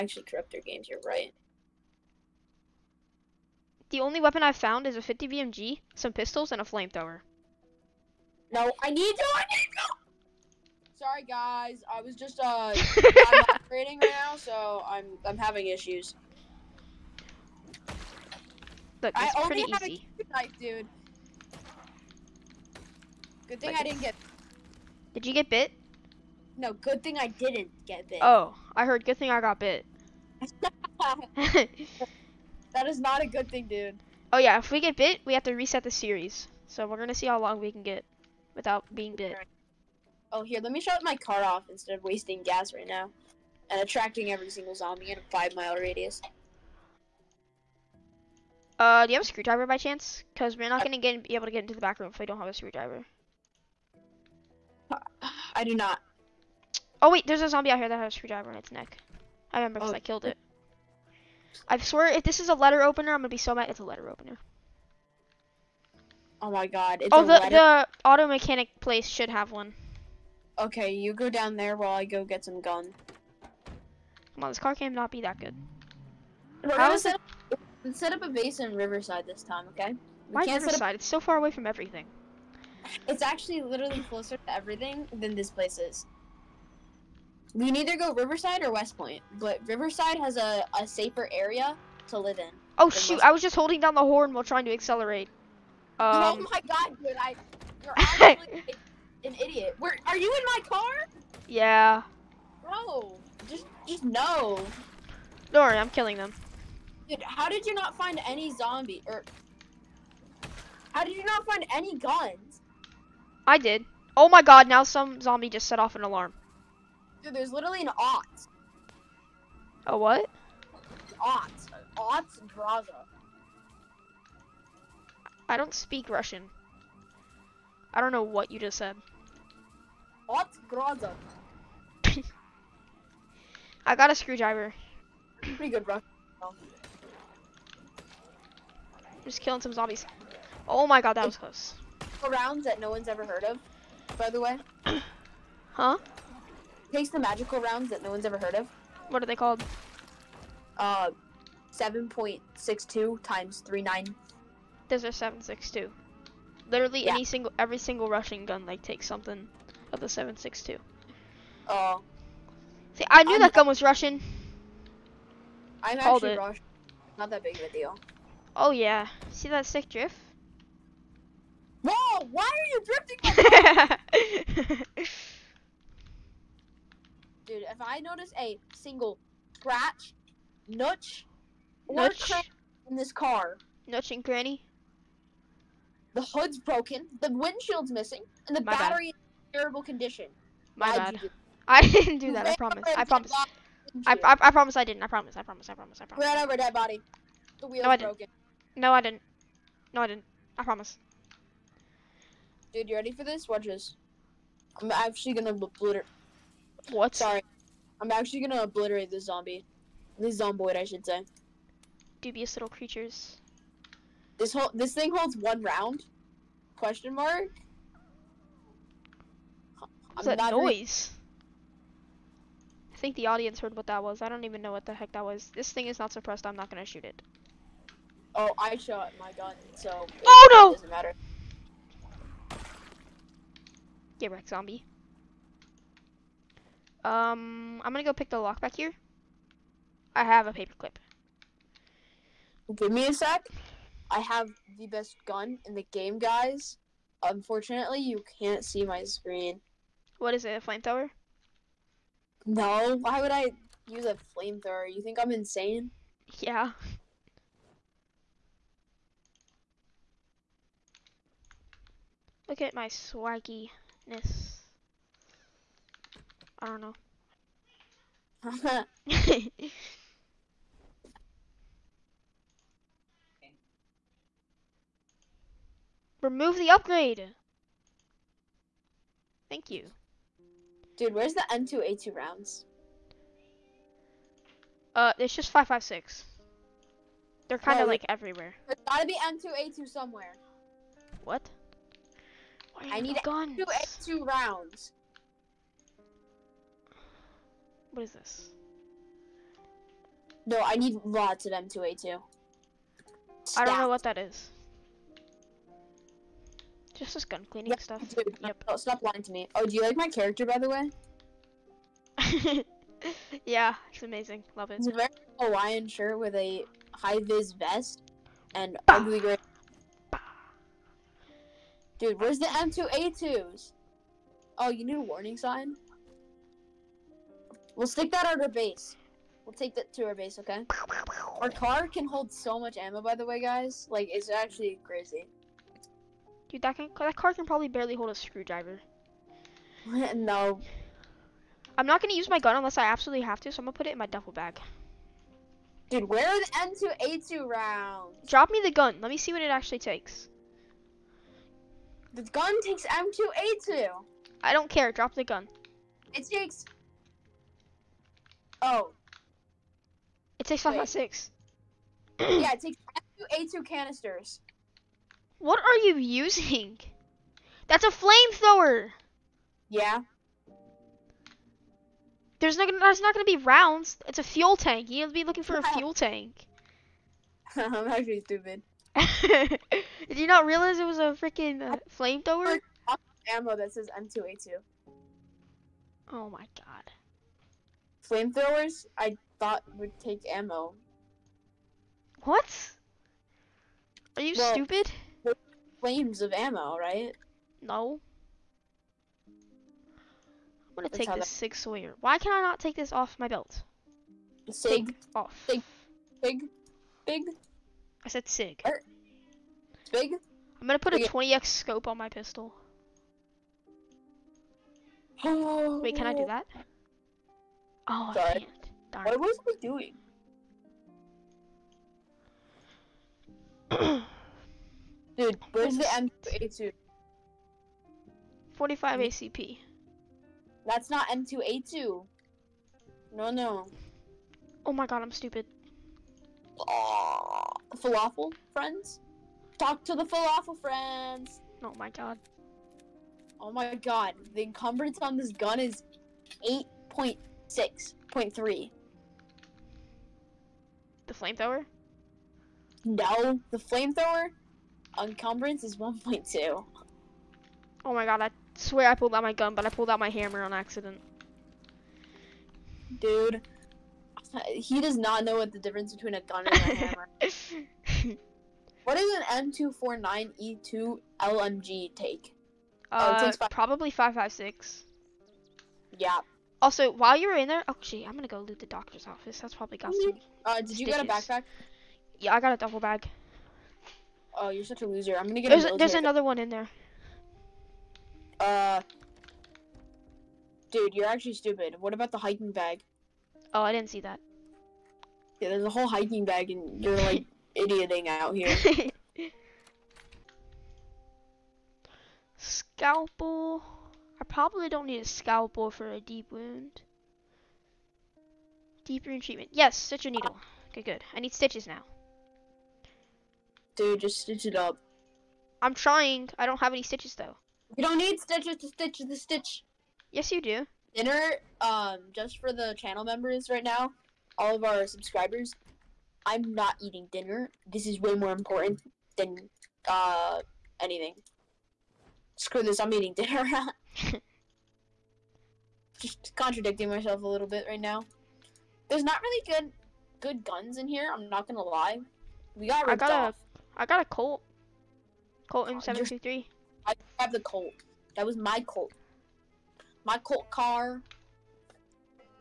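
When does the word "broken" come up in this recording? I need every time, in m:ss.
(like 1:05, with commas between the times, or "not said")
3:06, 3:17.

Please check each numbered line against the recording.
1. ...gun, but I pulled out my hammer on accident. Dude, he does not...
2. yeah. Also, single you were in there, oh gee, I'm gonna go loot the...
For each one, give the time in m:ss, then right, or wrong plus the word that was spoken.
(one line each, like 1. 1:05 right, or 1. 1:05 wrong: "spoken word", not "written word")
1. 7:39 right
2. 7:55 wrong: "while", not "single".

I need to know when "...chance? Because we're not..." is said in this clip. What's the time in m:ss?
0:49.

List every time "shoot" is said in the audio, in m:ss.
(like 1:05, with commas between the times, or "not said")
1:32, 3:46.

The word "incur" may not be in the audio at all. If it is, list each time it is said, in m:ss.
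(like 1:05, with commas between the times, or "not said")
not said.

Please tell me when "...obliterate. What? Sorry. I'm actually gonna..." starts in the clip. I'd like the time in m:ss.
3:25.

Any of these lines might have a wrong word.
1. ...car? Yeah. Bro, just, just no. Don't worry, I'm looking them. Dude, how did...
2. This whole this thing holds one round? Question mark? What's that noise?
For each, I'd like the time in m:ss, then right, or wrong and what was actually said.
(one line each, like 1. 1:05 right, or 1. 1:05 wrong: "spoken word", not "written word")
1. 1:40 wrong: "killing", not "looking"
2. 3:34 right.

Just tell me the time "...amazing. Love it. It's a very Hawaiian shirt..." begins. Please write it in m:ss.
5:14.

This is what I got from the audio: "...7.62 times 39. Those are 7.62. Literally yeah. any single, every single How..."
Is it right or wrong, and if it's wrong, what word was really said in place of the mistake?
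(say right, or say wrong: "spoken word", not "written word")
wrong: "Russian", not "How".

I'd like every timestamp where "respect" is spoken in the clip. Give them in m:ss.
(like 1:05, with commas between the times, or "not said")
not said.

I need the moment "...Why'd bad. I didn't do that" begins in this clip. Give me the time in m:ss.
3:10.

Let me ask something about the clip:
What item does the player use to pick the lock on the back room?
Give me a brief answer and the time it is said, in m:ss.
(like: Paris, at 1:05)
Paperclip, at 4:00.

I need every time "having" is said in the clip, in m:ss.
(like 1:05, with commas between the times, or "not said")
0:15.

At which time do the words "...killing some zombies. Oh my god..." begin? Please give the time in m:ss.
2:19.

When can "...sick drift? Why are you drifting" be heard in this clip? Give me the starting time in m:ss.
2:49.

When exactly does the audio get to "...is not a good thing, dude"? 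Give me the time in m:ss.
0:32.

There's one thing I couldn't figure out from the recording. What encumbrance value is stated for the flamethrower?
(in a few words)
1.2.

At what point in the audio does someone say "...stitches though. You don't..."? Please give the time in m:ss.
8:36.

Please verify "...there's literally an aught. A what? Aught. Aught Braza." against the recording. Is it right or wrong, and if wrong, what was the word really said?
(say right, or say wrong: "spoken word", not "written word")
right.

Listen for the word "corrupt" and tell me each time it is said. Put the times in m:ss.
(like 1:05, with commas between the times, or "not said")
0:00.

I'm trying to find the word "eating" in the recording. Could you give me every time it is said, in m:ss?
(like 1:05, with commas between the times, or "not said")
8:46, 8:52.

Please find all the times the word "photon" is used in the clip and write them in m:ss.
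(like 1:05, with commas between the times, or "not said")
not said.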